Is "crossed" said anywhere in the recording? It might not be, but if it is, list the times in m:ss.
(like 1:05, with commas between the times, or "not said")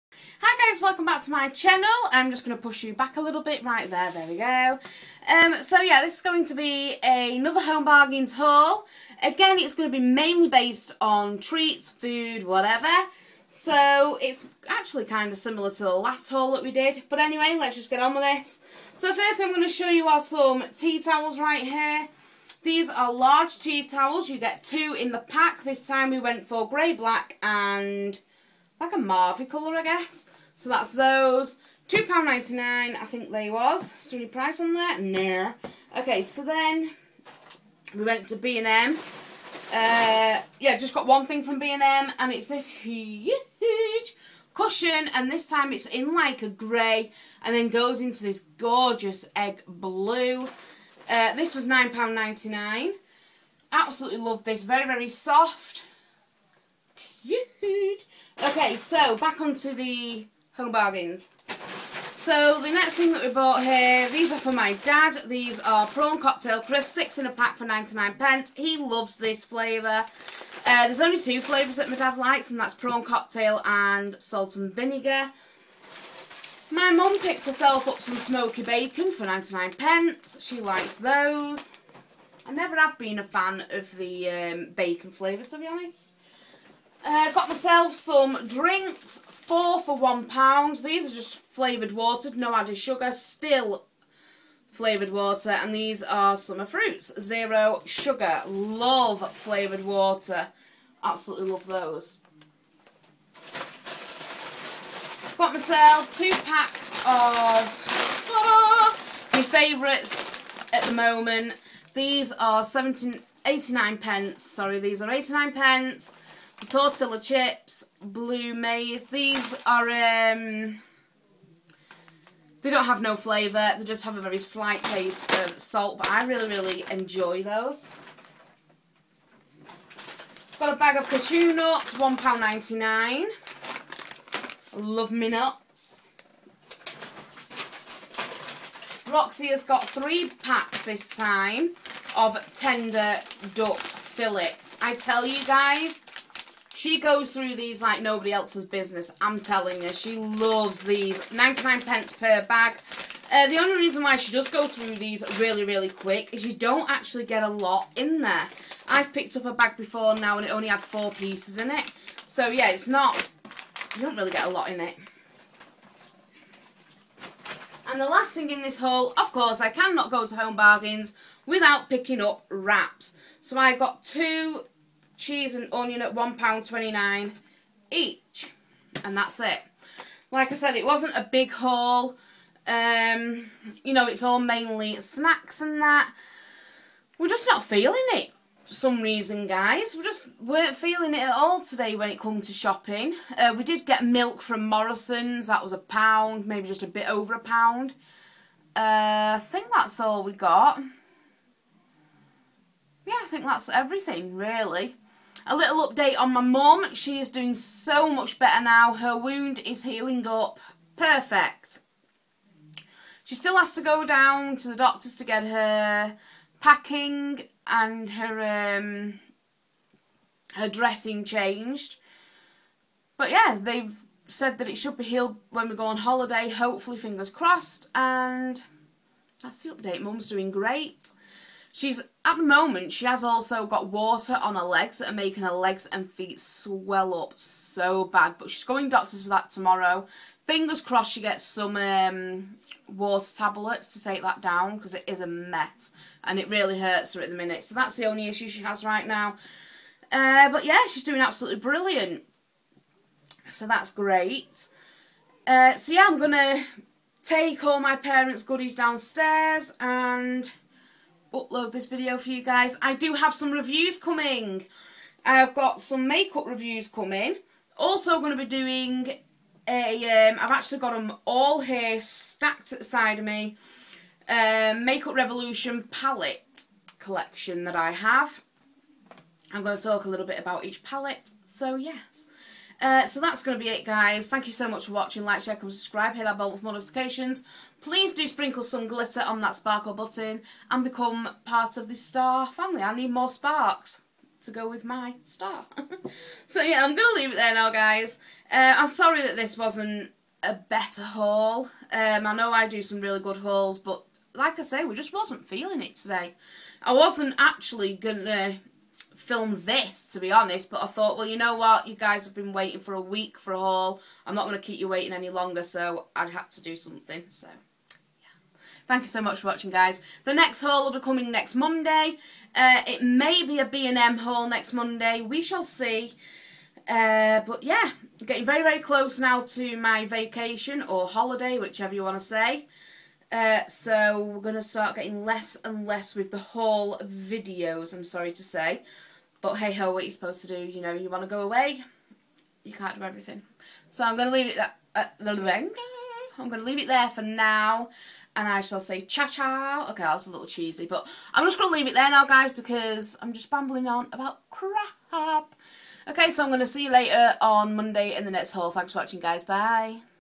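3:47, 4:00.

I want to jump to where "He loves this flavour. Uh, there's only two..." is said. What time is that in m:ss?
1:08.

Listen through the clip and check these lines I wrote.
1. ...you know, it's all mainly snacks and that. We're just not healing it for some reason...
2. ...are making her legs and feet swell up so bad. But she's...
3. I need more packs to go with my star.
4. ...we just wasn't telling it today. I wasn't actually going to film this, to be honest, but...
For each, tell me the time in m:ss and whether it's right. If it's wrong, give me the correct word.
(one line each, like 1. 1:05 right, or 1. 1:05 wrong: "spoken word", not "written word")
1. 3:03 wrong: "feeling", not "healing"
2. 3:55 right
3. 4:52 wrong: "sparks", not "packs"
4. 5:04 wrong: "feeling", not "telling".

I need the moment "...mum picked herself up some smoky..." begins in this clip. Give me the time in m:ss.
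1:16.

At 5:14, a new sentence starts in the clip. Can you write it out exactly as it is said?
I'm not going to keep you waiting any longer, so I had to do something, so...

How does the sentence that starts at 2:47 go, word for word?
And the last thing in this haul, of course, I cannot go to Home Bargains without picking up wraps.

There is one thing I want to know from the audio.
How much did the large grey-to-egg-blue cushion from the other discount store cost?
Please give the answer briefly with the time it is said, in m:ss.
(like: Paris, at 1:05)
£9.99, at 0:51.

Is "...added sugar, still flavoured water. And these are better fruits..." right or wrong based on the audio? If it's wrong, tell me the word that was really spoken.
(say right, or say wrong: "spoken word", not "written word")
wrong: "summer", not "better".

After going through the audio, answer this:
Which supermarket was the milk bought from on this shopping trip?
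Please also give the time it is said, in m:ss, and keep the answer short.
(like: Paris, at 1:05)
Morrison's, at 3:14.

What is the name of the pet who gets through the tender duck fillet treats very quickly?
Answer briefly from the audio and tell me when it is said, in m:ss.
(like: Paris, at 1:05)
Roxy, at 2:19.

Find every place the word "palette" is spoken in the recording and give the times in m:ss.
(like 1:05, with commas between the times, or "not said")
4:35, 4:40.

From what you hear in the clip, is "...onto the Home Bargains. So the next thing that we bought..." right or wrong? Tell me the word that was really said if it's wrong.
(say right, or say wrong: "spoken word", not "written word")
right.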